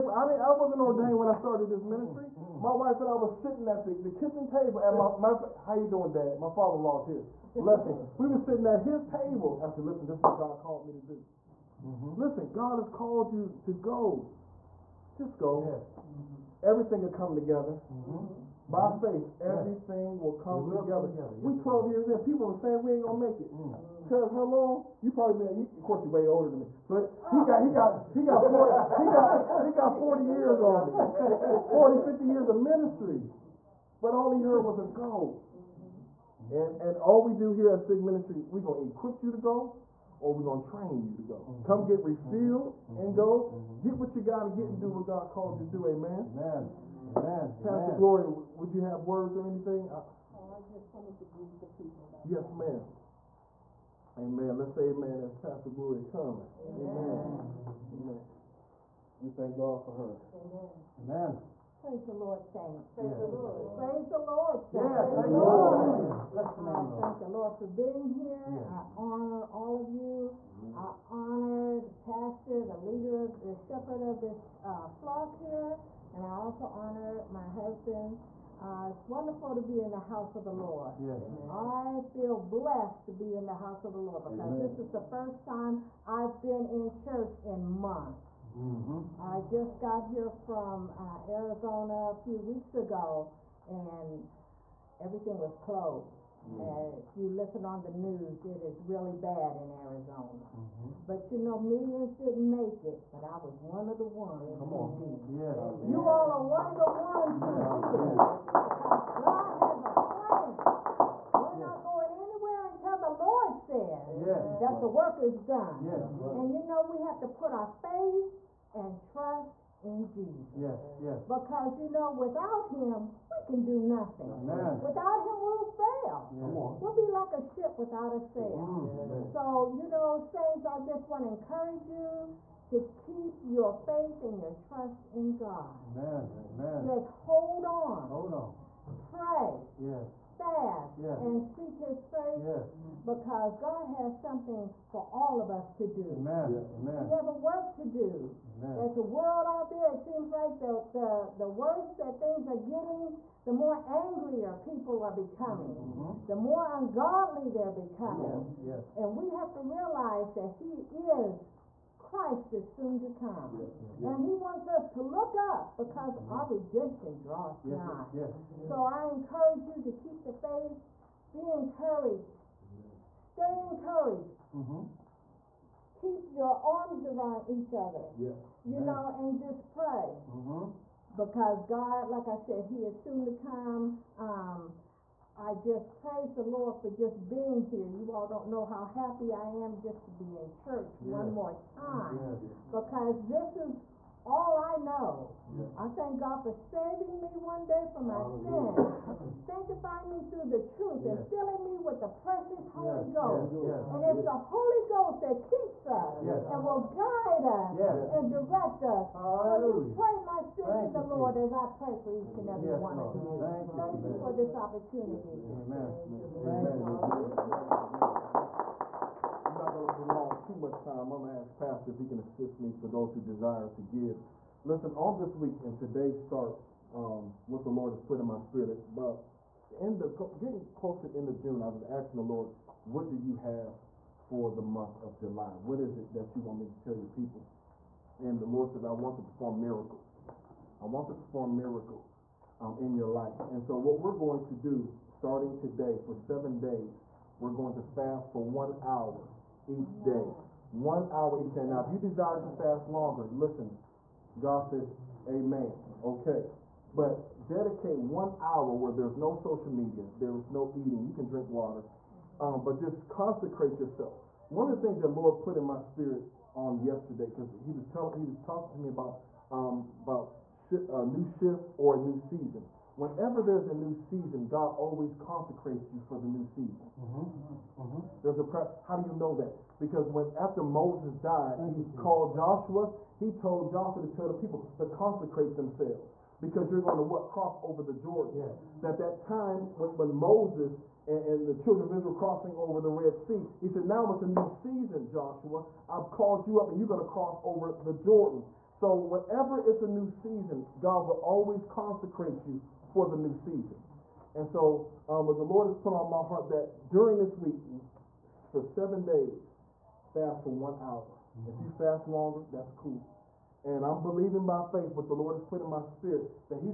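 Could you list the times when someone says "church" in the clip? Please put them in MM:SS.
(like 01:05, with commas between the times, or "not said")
01:26, 03:10.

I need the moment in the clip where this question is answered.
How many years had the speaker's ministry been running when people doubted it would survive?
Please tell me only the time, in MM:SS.
00:21.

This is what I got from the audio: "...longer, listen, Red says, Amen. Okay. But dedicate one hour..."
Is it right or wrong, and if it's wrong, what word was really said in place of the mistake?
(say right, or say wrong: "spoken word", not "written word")
wrong: "God", not "Red".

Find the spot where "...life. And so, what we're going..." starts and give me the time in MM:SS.
04:03.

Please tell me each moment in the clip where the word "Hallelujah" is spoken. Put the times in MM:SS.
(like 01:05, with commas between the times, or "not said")
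01:05, 03:29.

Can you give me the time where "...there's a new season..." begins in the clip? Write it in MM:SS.
04:33.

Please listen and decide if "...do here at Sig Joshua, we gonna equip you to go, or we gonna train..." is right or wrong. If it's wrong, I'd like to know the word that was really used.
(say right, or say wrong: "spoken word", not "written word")
wrong: "Ministry", not "Joshua".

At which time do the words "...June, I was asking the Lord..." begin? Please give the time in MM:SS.
03:51.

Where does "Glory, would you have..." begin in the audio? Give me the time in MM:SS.
00:48.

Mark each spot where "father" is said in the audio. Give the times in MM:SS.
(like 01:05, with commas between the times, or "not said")
00:06.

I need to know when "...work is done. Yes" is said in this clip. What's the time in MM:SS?
01:54.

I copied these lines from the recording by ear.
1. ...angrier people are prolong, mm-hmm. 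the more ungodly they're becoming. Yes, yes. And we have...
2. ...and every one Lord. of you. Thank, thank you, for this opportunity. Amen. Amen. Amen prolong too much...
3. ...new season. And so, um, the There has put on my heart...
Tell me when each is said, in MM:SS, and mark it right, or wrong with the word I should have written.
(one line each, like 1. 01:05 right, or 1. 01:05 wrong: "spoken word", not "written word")
1. 02:33 wrong: "becoming", not "prolong"
2. 03:32 right
3. 05:03 wrong: "Lord", not "There".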